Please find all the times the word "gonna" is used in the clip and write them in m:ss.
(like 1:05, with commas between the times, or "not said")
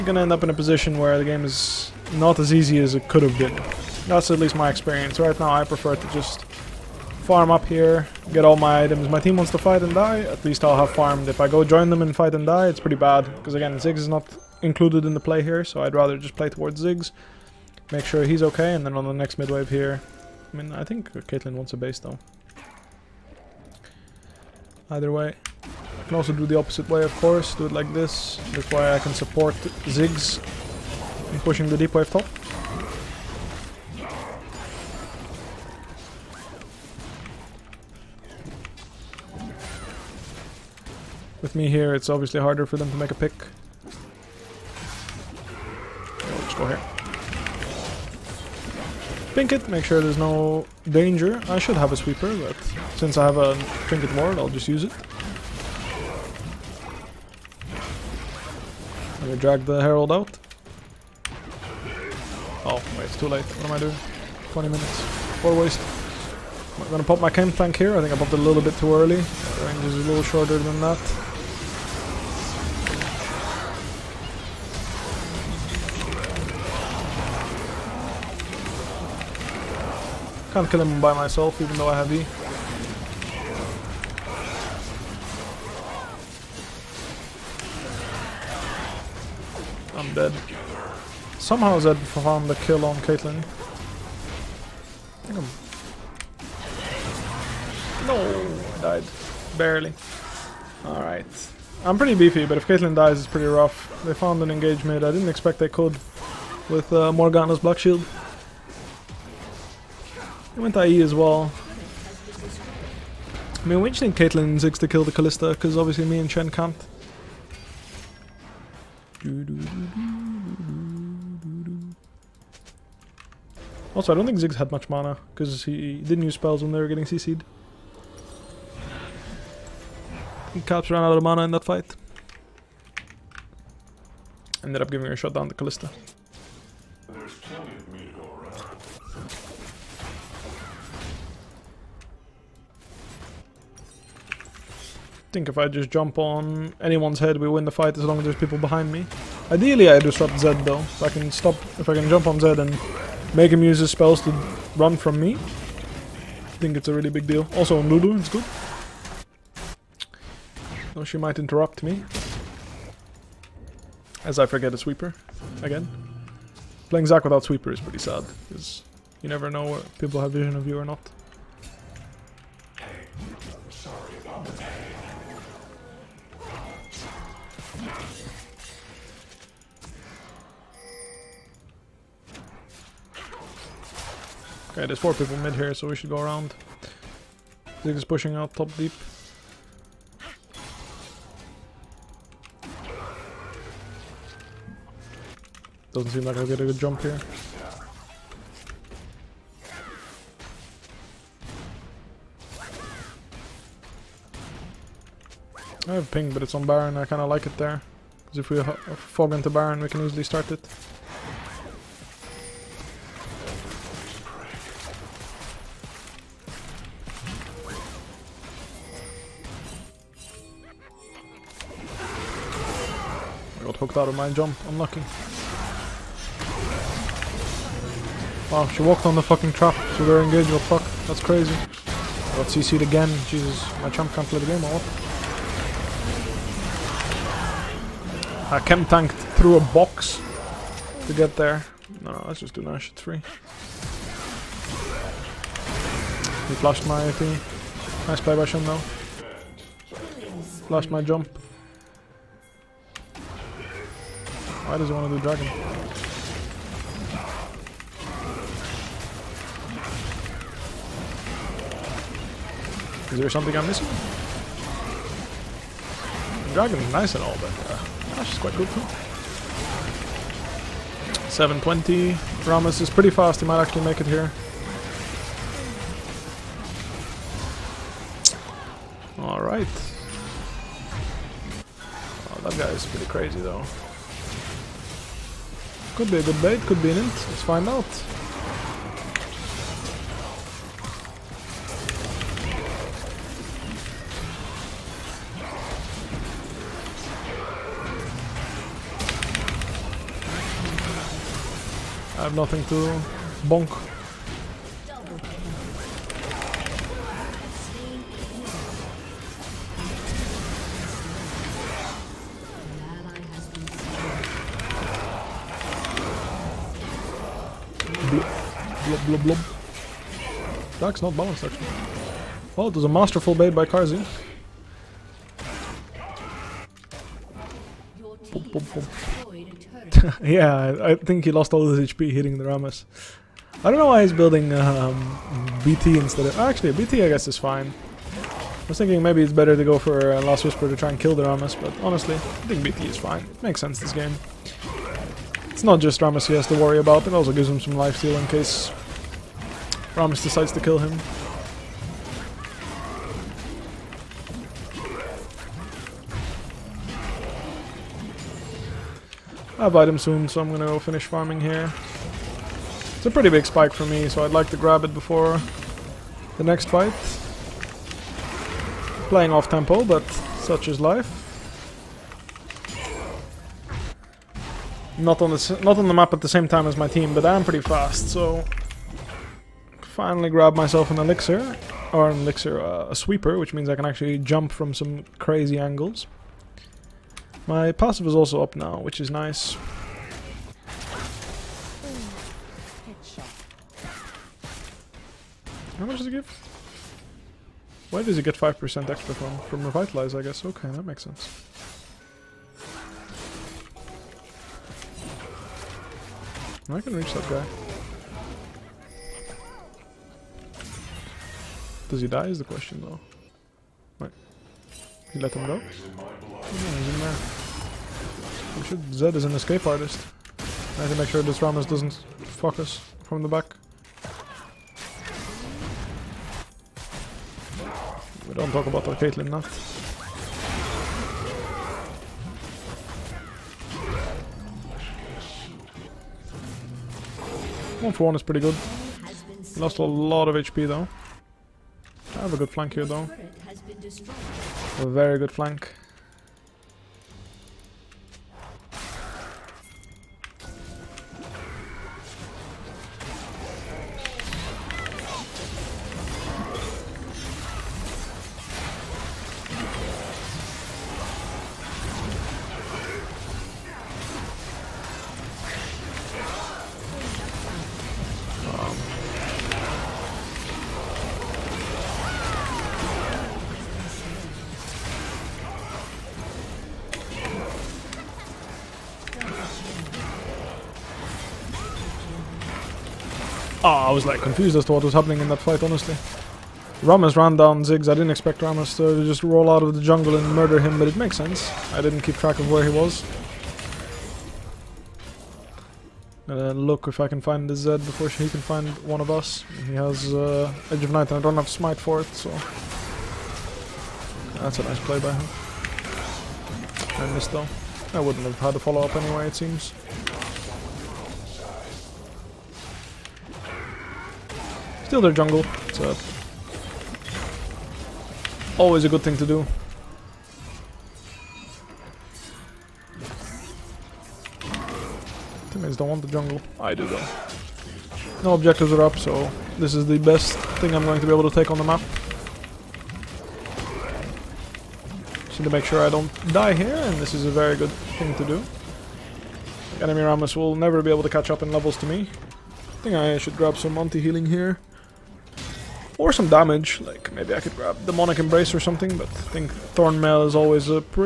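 0:00, 1:06, 6:00.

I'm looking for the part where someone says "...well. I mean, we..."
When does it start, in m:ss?
1:51.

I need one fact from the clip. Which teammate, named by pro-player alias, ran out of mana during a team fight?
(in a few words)
Caps.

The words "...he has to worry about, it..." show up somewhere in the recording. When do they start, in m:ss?
5:46.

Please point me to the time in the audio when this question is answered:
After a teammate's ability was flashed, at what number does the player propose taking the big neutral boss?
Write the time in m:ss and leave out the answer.
4:02.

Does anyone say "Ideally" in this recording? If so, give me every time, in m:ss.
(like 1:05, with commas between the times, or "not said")
2:29.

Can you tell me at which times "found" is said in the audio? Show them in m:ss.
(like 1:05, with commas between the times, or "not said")
1:31, 1:44.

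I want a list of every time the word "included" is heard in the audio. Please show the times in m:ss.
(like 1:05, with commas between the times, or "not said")
0:14.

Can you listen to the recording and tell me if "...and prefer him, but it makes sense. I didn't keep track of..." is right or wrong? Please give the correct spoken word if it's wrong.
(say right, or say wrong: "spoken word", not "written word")
wrong: "murder", not "prefer".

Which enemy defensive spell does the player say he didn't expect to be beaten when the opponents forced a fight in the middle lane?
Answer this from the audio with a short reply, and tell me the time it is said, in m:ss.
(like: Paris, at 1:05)
Black Shield, at 1:47.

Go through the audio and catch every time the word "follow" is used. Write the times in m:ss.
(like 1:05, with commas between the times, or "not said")
8:28.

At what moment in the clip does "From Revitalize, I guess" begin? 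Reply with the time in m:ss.
6:39.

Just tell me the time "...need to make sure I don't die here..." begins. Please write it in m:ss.
8:55.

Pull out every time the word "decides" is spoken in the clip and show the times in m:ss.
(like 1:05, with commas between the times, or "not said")
5:50.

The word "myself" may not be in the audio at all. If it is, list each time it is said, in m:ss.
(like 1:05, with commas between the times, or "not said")
1:21, 6:20.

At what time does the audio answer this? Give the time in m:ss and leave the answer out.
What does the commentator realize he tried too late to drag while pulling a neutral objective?
0:59.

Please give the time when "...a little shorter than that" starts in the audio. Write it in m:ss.
1:10.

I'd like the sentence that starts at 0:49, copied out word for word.
Pink it, make sure there's no danger.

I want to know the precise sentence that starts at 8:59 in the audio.
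Enemy Rammus will never be able to catch up in levels to me.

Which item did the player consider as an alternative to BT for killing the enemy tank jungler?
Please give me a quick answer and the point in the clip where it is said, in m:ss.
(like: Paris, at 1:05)
Last Whisper, at 5:40.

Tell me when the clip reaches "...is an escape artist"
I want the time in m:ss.
6:59.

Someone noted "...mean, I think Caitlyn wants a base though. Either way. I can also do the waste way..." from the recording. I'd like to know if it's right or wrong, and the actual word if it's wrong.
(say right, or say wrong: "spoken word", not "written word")
wrong: "opposite", not "waste".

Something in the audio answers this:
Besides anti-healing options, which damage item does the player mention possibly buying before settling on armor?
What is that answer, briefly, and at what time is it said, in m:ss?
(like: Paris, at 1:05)
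Demonic Embrace, at 9:07.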